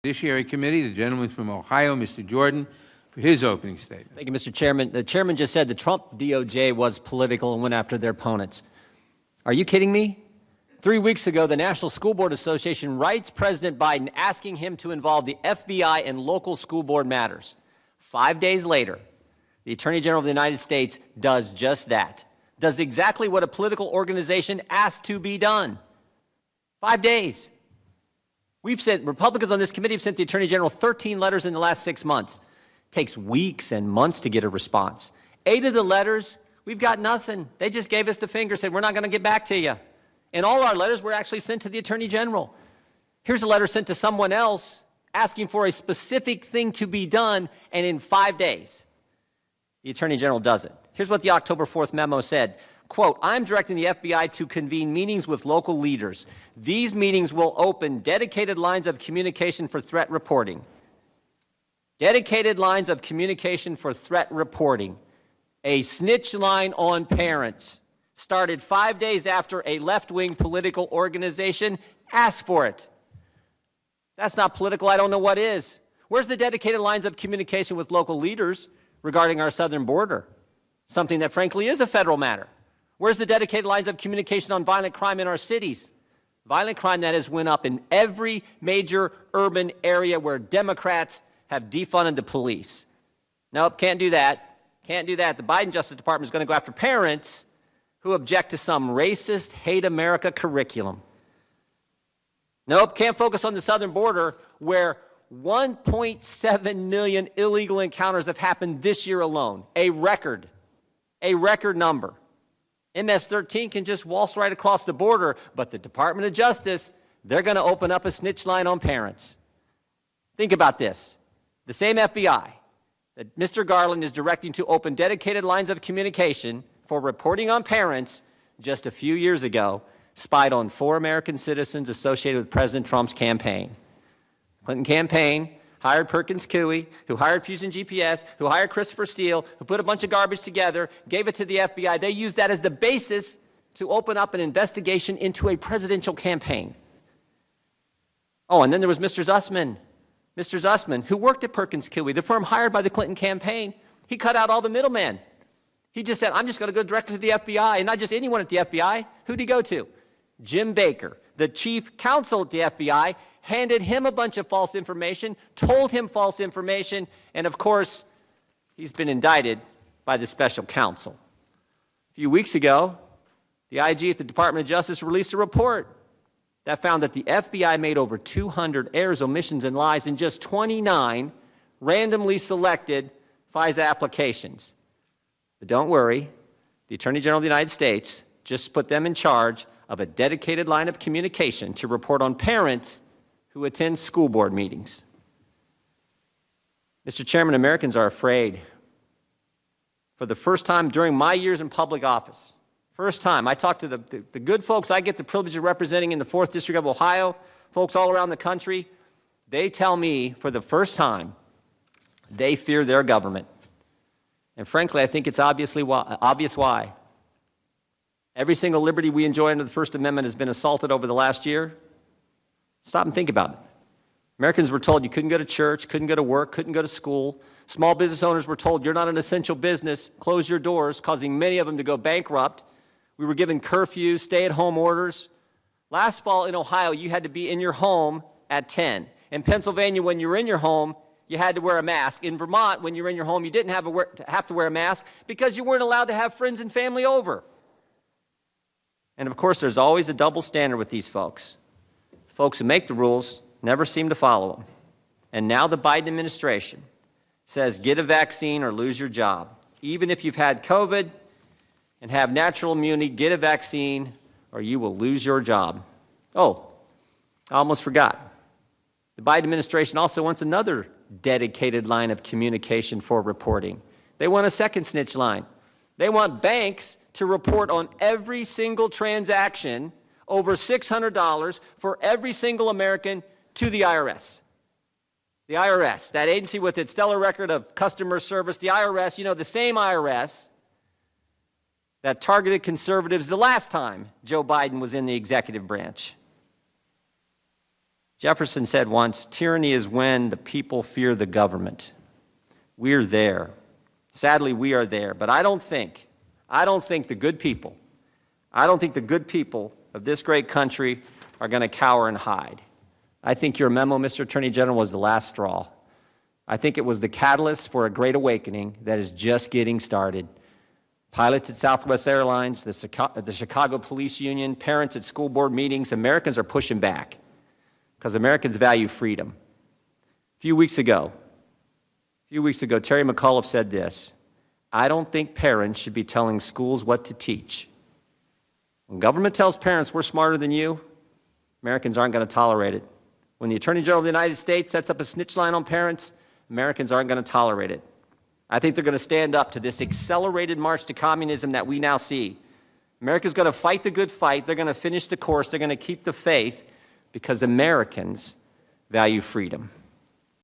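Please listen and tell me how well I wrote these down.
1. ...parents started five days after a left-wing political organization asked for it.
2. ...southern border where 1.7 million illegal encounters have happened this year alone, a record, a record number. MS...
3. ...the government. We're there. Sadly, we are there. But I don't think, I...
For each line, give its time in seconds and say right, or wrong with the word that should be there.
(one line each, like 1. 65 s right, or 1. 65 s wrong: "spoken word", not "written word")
1. 67 s right
2. 103 s right
3. 301 s right.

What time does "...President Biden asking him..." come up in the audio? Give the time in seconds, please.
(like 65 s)
13 s.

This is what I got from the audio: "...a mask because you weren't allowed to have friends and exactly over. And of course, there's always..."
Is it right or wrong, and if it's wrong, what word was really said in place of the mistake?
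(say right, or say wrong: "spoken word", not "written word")
wrong: "family", not "exactly".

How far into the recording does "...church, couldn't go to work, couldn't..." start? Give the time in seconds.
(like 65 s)
225 s.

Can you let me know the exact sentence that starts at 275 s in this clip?
They want banks to report on every single transaction over $600 for every single American to the IRS.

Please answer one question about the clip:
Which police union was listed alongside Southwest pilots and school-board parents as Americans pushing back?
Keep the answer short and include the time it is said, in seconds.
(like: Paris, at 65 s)
Chicago Police Union, at 323 s.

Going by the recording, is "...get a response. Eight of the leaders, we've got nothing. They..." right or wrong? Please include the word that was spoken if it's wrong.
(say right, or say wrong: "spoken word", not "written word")
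wrong: "letters", not "leaders".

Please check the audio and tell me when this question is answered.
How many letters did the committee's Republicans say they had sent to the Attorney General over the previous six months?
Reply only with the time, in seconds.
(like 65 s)
30 s.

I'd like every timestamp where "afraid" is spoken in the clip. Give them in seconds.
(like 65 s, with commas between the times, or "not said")
198 s.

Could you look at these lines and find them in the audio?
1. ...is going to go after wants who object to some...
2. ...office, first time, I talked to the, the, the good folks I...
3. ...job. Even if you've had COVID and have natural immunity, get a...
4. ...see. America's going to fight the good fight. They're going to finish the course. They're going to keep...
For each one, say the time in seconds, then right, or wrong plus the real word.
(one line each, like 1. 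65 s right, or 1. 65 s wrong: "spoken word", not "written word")
1. 96 s wrong: "parents", not "wants"
2. 202 s right
3. 259 s right
4. 351 s right.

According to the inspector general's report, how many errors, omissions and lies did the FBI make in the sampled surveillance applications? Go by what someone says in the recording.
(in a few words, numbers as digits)
over 200.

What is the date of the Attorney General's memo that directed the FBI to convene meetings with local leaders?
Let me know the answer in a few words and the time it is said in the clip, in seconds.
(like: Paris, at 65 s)
October 4th, at 51 s.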